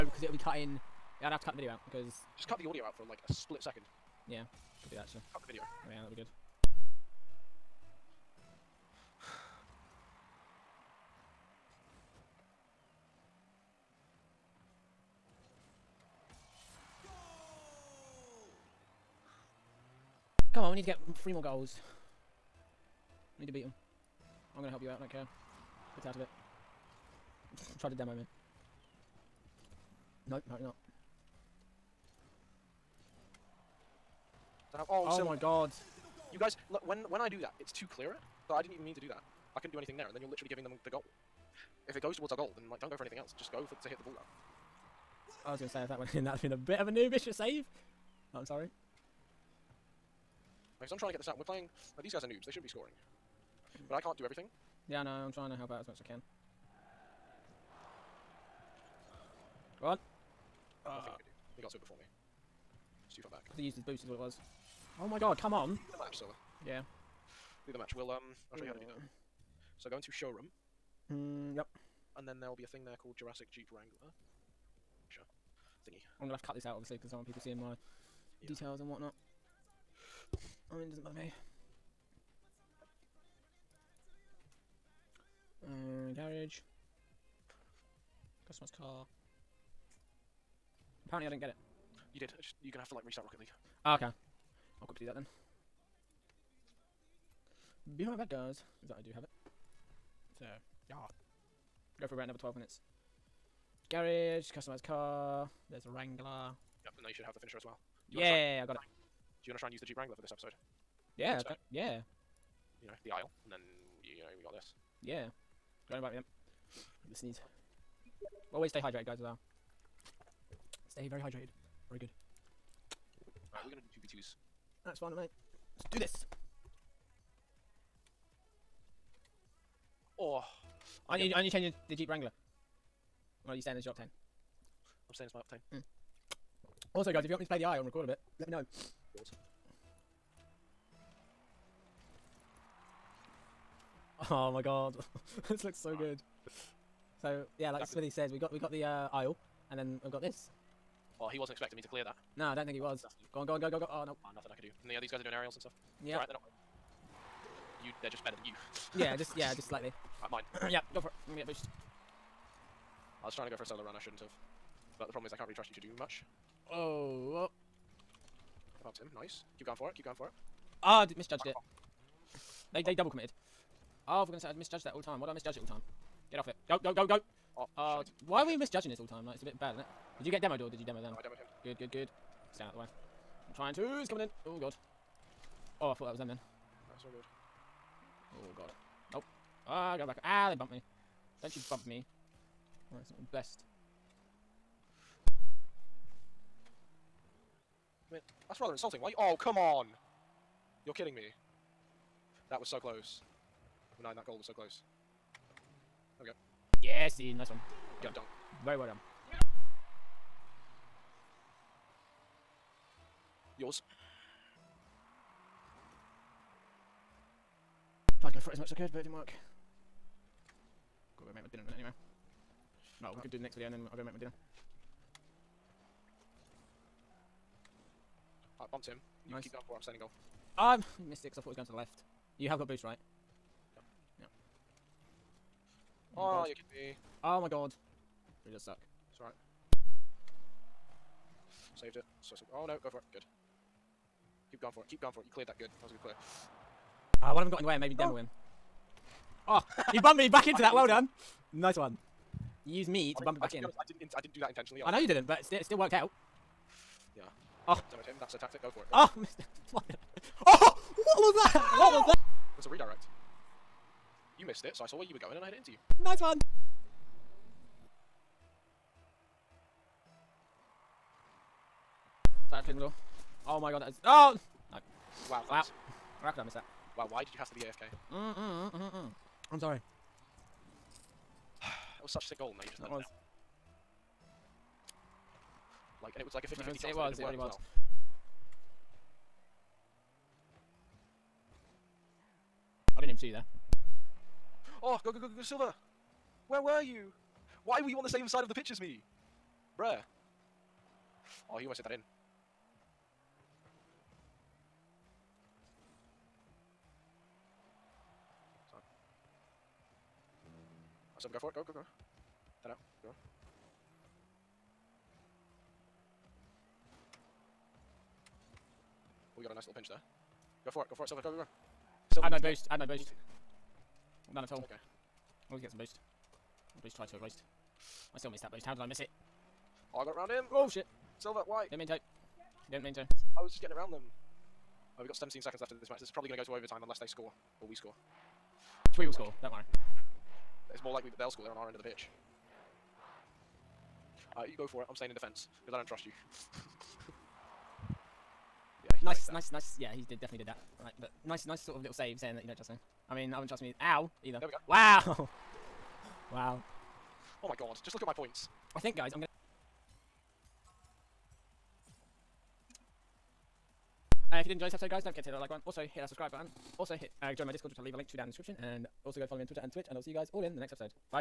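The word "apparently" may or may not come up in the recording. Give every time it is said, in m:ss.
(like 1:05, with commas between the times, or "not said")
0:30, 1:31.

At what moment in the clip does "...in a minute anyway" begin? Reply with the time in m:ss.
3:41.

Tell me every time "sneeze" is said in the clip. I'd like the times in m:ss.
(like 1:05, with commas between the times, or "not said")
1:57.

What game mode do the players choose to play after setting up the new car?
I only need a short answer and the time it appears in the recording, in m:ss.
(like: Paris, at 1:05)
2v2s, at 2:04.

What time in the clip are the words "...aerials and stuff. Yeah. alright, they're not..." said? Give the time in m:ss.
2:35.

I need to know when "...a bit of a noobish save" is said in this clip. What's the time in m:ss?
0:46.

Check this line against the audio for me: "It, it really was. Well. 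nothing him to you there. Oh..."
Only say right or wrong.
wrong.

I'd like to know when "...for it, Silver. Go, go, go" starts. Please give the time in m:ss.
5:20.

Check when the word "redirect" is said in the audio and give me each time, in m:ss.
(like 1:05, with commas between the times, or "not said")
4:22.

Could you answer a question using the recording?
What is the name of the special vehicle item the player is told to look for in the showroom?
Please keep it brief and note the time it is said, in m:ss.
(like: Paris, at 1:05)
Jurassic Jeep Wrangler, at 1:13.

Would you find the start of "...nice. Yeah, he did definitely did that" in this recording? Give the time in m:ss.
5:49.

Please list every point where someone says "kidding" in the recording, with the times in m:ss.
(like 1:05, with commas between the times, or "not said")
3:20, 3:56.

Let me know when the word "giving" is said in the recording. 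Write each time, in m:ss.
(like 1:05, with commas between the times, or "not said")
0:40.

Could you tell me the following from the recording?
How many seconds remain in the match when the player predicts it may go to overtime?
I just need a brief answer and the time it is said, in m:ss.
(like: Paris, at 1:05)
17, at 5:35.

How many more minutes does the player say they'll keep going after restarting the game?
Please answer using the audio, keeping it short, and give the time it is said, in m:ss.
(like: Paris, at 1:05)
12, at 1:42.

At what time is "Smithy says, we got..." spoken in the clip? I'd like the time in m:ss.
2:27.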